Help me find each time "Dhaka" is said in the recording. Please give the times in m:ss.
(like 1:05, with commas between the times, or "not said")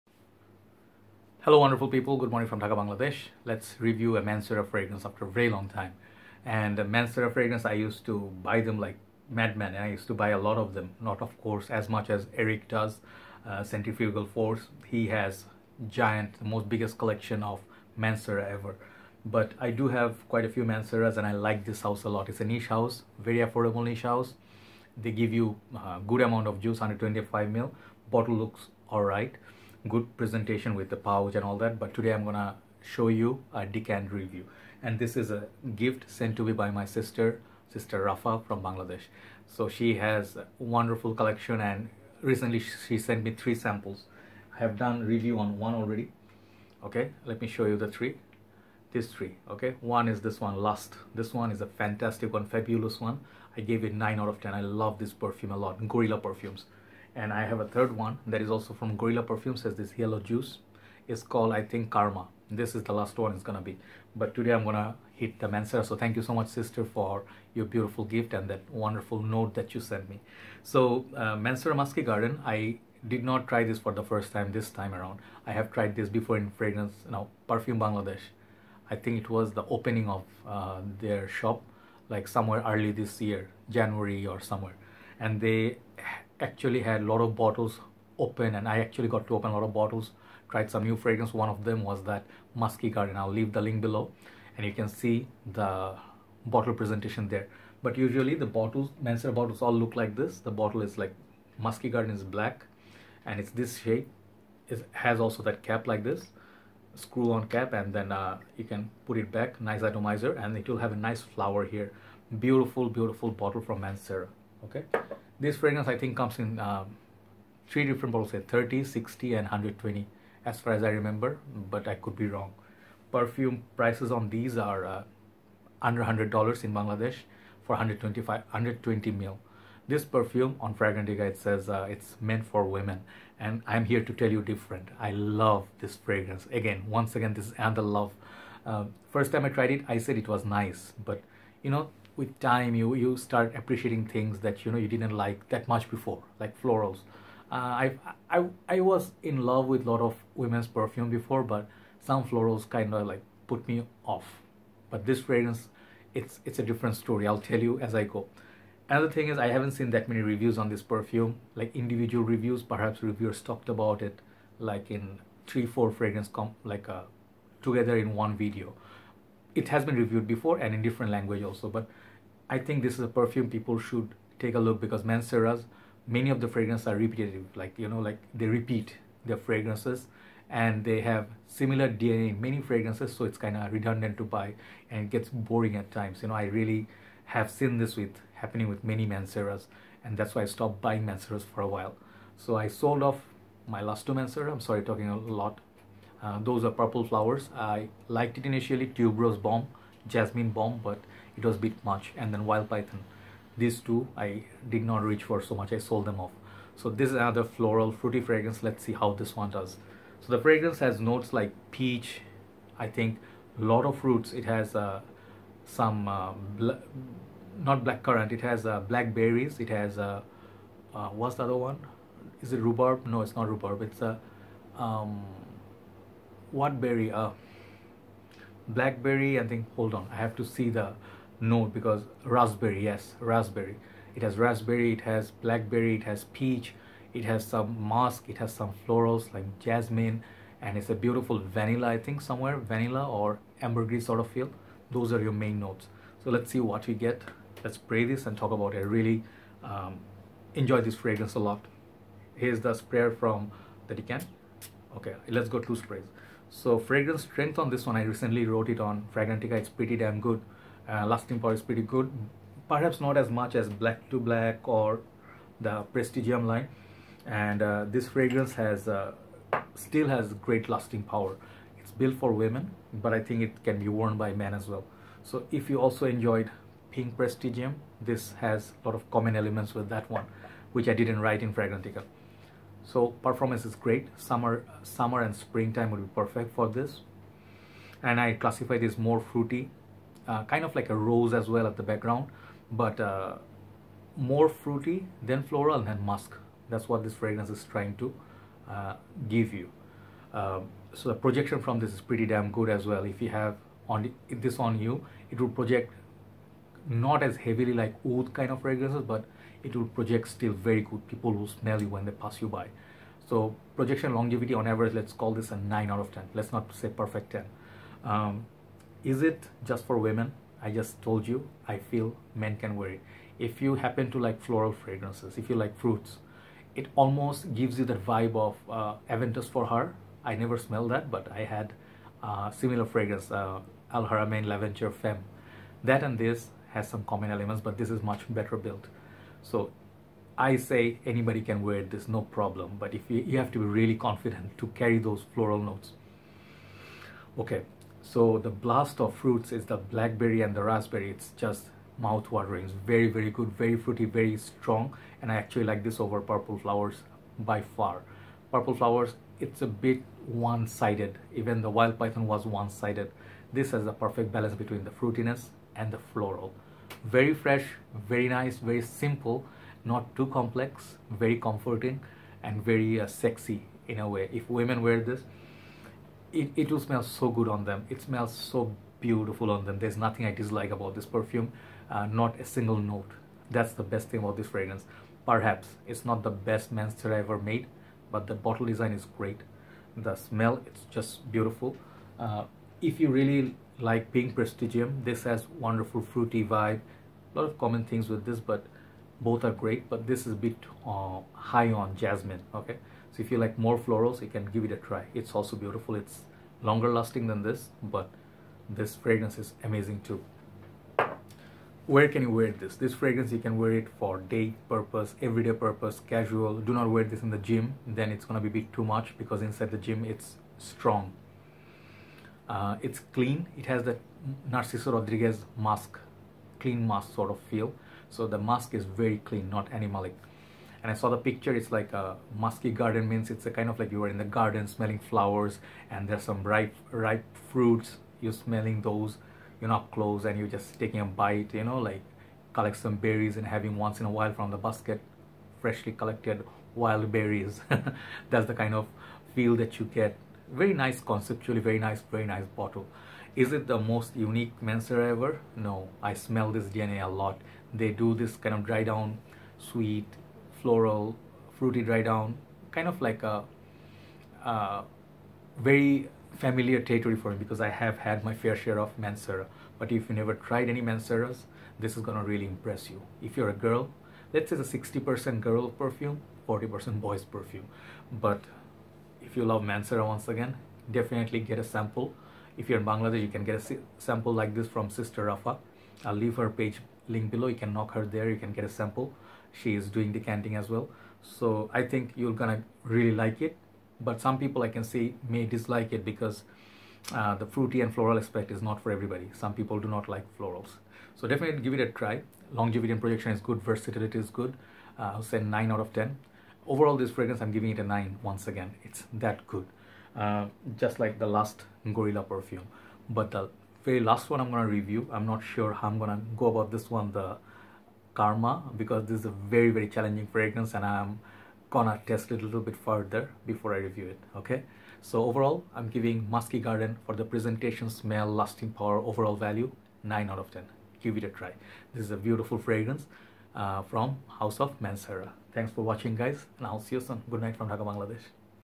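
0:02, 8:57.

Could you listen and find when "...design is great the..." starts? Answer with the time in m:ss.
6:28.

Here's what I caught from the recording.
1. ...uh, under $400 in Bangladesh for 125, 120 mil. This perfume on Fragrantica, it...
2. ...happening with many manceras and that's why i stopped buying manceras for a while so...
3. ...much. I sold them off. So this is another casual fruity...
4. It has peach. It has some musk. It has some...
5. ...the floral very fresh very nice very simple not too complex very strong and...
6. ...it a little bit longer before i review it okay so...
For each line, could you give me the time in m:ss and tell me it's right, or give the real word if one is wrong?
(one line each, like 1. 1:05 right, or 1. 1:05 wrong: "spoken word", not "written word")
1. 2:04 wrong: "100", not "400"
2. 3:08 right
3. 3:25 wrong: "floral", not "casual"
4. 3:55 right
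5. 6:05 wrong: "comforting", not "strong"
6. 8:42 wrong: "further", not "longer".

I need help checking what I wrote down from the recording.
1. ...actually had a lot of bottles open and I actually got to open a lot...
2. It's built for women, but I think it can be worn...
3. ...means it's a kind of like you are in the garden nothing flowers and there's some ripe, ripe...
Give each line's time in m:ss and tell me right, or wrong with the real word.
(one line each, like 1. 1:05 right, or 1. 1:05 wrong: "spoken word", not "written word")
1. 1:26 right
2. 4:31 right
3. 7:13 wrong: "smelling", not "nothing".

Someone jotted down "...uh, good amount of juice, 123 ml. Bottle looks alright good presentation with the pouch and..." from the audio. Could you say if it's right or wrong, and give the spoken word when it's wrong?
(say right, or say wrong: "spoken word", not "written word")
wrong: "125", not "123".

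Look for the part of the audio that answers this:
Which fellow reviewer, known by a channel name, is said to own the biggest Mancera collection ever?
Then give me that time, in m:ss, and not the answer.
0:13.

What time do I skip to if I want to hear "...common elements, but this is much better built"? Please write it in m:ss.
5:37.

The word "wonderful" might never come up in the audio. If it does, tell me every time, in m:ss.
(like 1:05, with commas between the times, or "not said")
0:01, 0:40, 1:08, 6:35.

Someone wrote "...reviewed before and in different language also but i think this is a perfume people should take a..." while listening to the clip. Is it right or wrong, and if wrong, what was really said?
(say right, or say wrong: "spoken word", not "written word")
right.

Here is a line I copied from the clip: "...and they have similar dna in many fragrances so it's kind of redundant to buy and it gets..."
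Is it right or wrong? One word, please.
right.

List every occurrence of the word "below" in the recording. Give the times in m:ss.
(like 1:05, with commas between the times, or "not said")
1:33, 8:07.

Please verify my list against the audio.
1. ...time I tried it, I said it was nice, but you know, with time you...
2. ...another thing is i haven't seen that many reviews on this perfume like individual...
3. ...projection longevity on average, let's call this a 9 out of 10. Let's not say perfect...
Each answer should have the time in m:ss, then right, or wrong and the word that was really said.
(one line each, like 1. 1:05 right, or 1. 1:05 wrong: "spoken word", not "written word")
1. 2:19 right
2. 2:38 right
3. 5:13 right.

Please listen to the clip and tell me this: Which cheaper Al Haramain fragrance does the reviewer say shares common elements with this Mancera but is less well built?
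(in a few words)
L'Aventure Femme.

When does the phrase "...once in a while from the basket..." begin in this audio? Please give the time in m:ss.
7:23.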